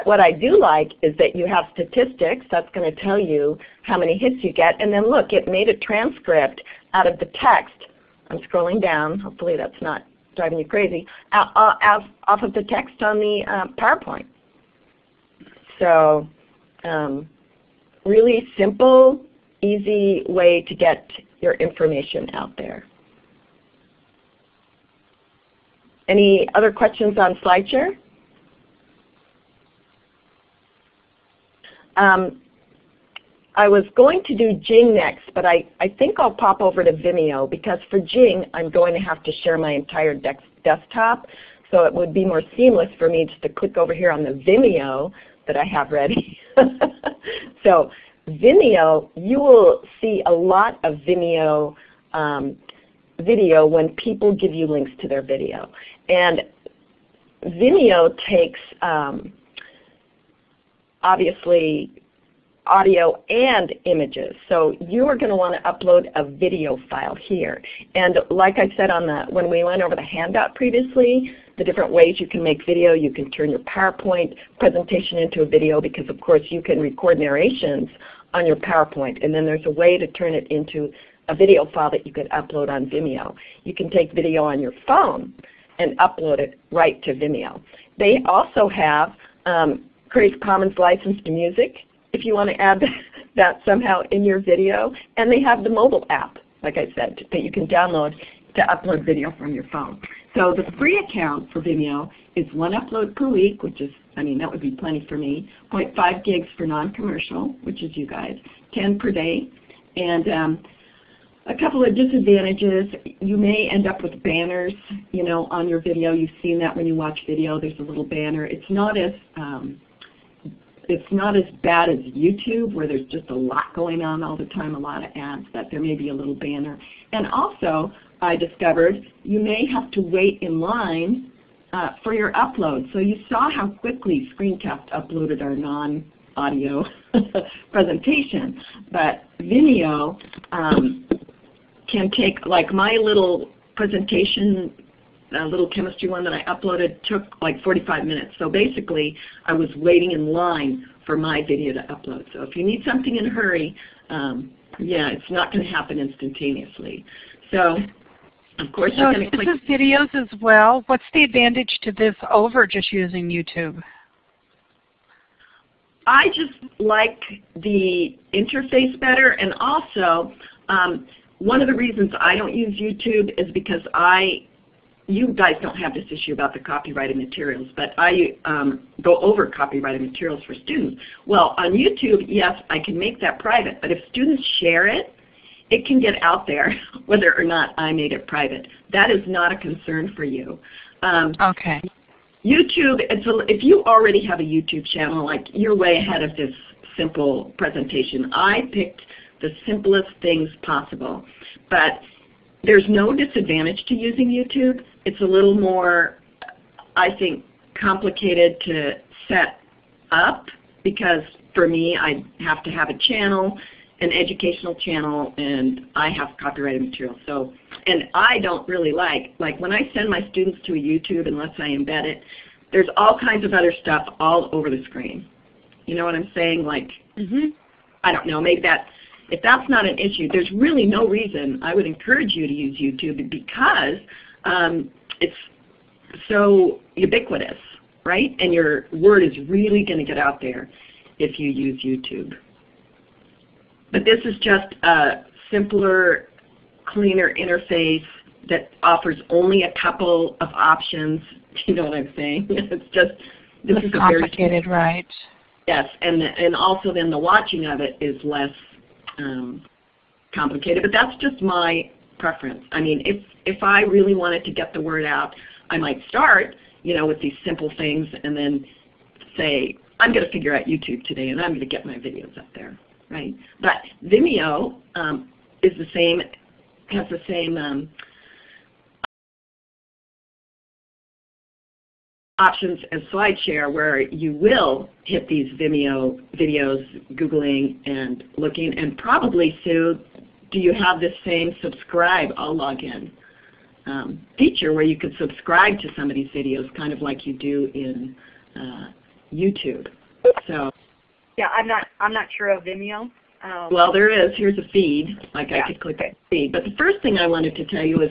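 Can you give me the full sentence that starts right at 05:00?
So yeah, I'm not I'm not sure of Vimeo.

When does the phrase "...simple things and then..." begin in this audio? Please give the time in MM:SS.
04:27.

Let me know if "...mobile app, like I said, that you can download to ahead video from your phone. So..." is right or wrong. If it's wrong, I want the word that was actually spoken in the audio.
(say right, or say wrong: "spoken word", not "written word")
wrong: "upload", not "ahead".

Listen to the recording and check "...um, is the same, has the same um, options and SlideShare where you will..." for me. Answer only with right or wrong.
right.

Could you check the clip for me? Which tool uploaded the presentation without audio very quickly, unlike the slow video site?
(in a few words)
Screencast.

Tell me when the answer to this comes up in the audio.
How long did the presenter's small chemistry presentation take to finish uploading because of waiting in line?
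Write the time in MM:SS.
02:27.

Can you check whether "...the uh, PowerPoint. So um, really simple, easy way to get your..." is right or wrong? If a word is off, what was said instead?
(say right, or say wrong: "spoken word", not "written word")
right.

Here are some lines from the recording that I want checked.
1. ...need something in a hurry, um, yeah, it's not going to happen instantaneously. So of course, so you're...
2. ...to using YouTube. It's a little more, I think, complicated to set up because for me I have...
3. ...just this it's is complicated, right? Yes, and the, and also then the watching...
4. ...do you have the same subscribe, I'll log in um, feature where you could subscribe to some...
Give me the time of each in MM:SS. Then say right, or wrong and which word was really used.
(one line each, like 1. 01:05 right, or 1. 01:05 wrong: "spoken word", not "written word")
1. 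02:32 right
2. 03:23 right
3. 04:12 right
4. 04:50 right.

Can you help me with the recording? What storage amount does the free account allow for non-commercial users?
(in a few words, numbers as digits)
0.5 gigs.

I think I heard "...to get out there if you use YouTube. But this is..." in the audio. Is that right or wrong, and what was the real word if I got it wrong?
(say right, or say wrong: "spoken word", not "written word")
right.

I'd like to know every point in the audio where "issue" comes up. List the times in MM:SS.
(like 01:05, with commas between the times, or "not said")
02:56, 03:49.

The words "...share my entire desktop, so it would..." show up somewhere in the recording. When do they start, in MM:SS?
00:39.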